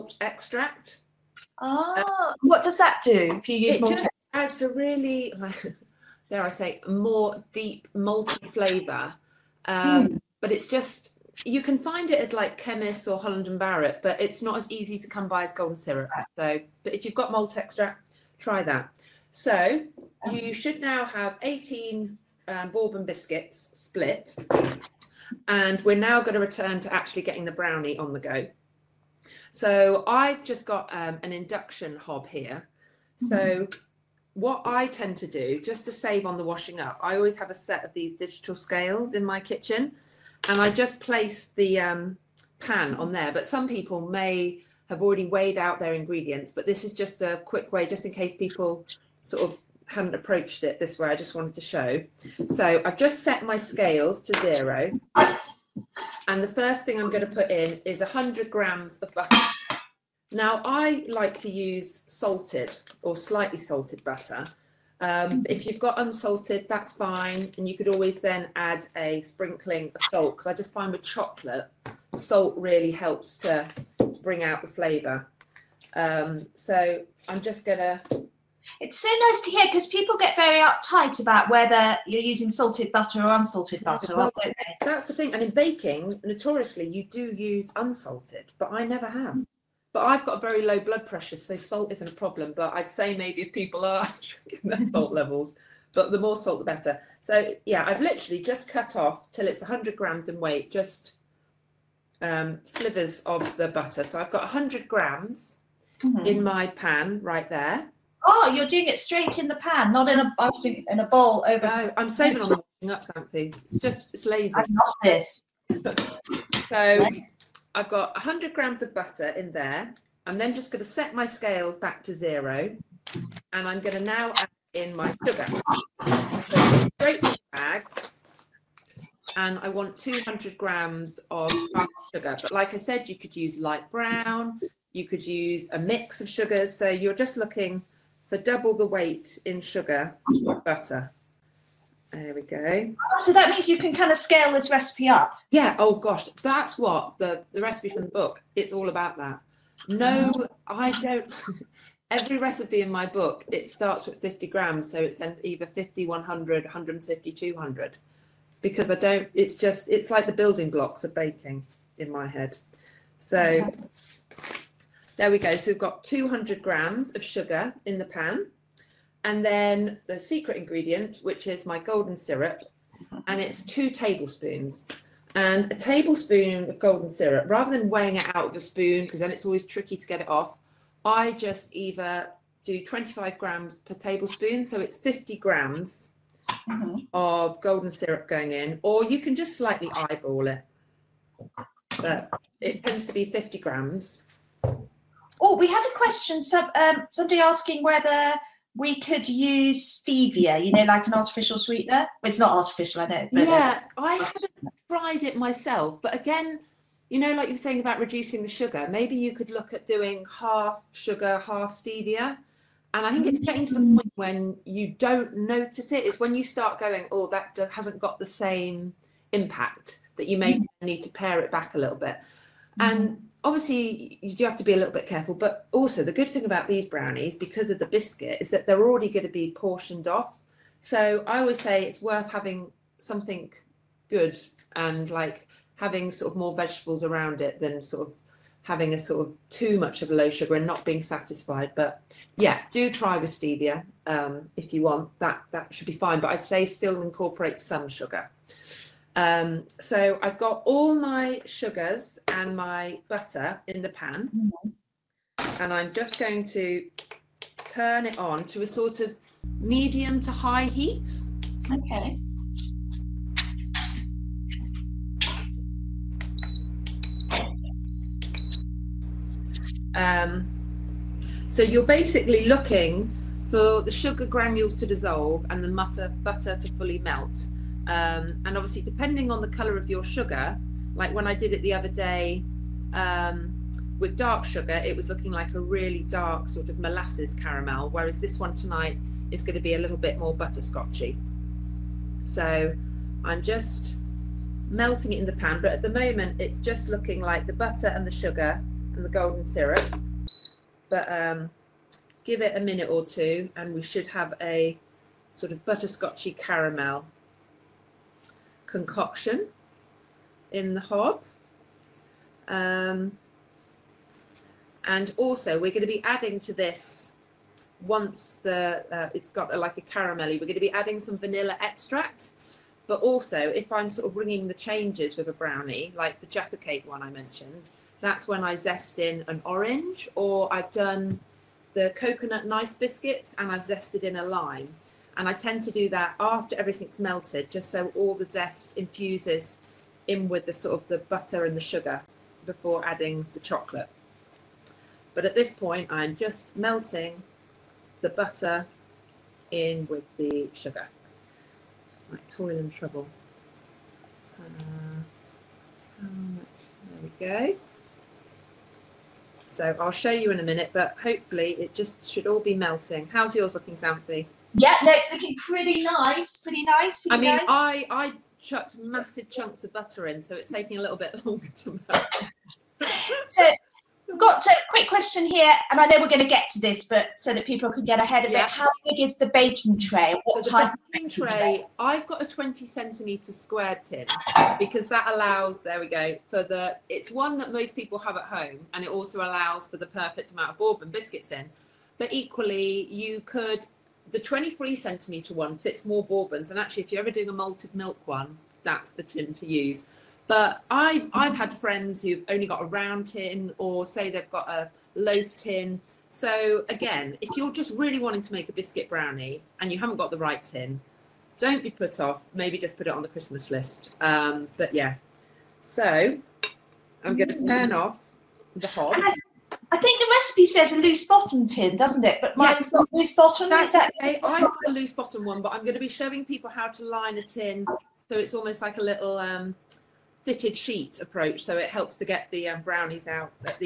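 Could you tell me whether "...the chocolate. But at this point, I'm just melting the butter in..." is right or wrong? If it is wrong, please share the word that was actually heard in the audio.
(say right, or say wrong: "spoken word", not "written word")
right.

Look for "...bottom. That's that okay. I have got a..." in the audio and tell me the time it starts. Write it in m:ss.
7:03.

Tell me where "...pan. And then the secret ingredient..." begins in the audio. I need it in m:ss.
2:48.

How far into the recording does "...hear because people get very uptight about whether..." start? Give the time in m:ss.
1:19.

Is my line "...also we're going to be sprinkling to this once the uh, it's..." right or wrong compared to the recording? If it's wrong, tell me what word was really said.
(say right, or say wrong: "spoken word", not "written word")
wrong: "adding", not "sprinkling".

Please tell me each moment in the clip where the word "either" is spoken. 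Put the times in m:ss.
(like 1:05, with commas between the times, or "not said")
2:35, 3:01.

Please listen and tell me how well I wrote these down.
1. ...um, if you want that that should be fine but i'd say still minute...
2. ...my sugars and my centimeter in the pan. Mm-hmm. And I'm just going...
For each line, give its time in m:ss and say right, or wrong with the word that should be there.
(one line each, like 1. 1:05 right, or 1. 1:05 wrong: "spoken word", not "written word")
1. 4:04 wrong: "incorporate", not "minute"
2. 4:10 wrong: "butter", not "centimeter".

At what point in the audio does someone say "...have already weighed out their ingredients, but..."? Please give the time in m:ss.
0:44.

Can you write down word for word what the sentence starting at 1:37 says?
So yeah, I've literally just cut off till it's 100 grams in weight, just um, slivers of the butter.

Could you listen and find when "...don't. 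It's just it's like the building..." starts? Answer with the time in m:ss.
2:38.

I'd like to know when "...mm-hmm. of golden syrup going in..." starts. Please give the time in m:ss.
3:06.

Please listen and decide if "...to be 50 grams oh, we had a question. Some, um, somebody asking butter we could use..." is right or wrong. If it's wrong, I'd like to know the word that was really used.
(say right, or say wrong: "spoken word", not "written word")
wrong: "whether", not "butter".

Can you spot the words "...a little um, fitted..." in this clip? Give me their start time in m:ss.
7:08.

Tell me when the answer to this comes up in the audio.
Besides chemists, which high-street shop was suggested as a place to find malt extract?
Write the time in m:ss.
0:13.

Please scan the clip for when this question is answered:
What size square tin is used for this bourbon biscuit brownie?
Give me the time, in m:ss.
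6:22.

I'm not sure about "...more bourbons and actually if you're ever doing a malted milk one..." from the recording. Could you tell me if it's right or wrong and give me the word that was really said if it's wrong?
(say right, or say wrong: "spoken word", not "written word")
right.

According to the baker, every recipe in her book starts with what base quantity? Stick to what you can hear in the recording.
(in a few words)
50 grams.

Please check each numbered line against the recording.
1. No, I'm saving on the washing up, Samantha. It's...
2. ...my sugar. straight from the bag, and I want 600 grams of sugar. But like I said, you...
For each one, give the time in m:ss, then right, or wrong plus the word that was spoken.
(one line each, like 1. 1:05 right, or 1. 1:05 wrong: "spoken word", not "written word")
1. 1:51 right
2. 2:04 wrong: "200", not "600".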